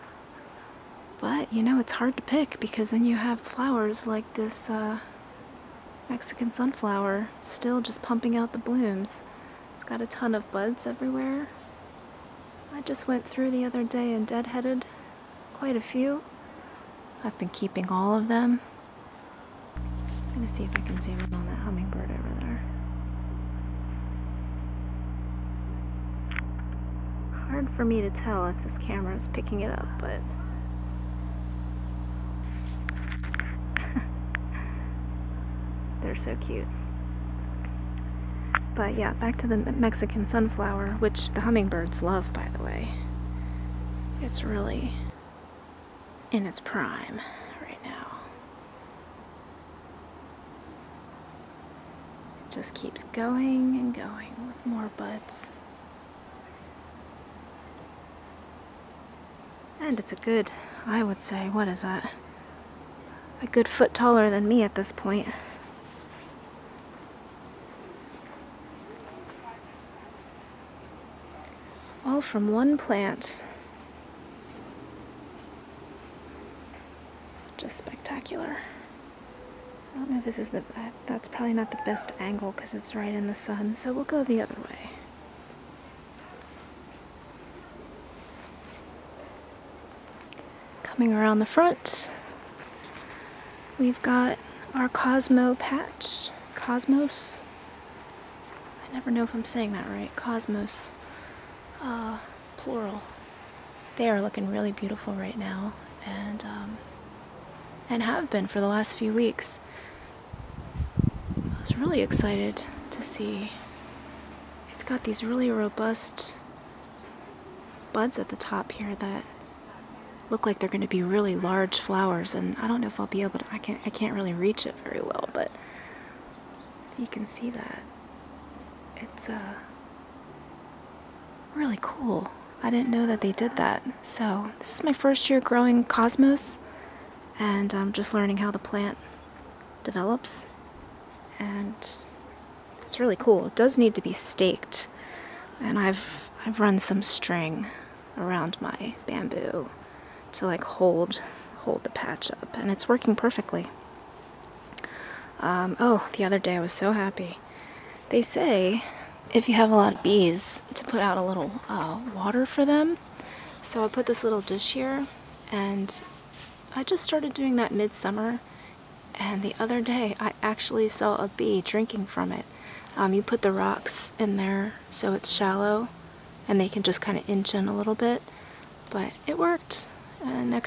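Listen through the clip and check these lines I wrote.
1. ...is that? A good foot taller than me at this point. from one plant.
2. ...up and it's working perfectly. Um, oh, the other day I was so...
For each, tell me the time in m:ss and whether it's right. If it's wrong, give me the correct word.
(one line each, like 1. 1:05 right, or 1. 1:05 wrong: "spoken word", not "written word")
1. 1:01 right
2. 2:32 right.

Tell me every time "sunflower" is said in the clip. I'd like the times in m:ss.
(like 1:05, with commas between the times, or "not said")
0:06, 0:40.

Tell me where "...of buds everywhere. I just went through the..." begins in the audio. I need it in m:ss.
0:10.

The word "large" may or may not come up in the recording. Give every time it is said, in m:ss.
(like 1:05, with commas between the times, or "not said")
2:01.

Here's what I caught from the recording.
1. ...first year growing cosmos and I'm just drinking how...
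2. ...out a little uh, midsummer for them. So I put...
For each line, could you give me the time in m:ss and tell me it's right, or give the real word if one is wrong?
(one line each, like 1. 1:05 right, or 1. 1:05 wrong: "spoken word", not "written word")
1. 2:14 wrong: "learning", not "drinking"
2. 2:40 wrong: "water", not "midsummer".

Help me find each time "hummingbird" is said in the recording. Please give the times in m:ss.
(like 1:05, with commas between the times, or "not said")
0:21, 0:41.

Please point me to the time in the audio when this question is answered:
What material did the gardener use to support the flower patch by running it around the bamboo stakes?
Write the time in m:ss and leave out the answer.
2:27.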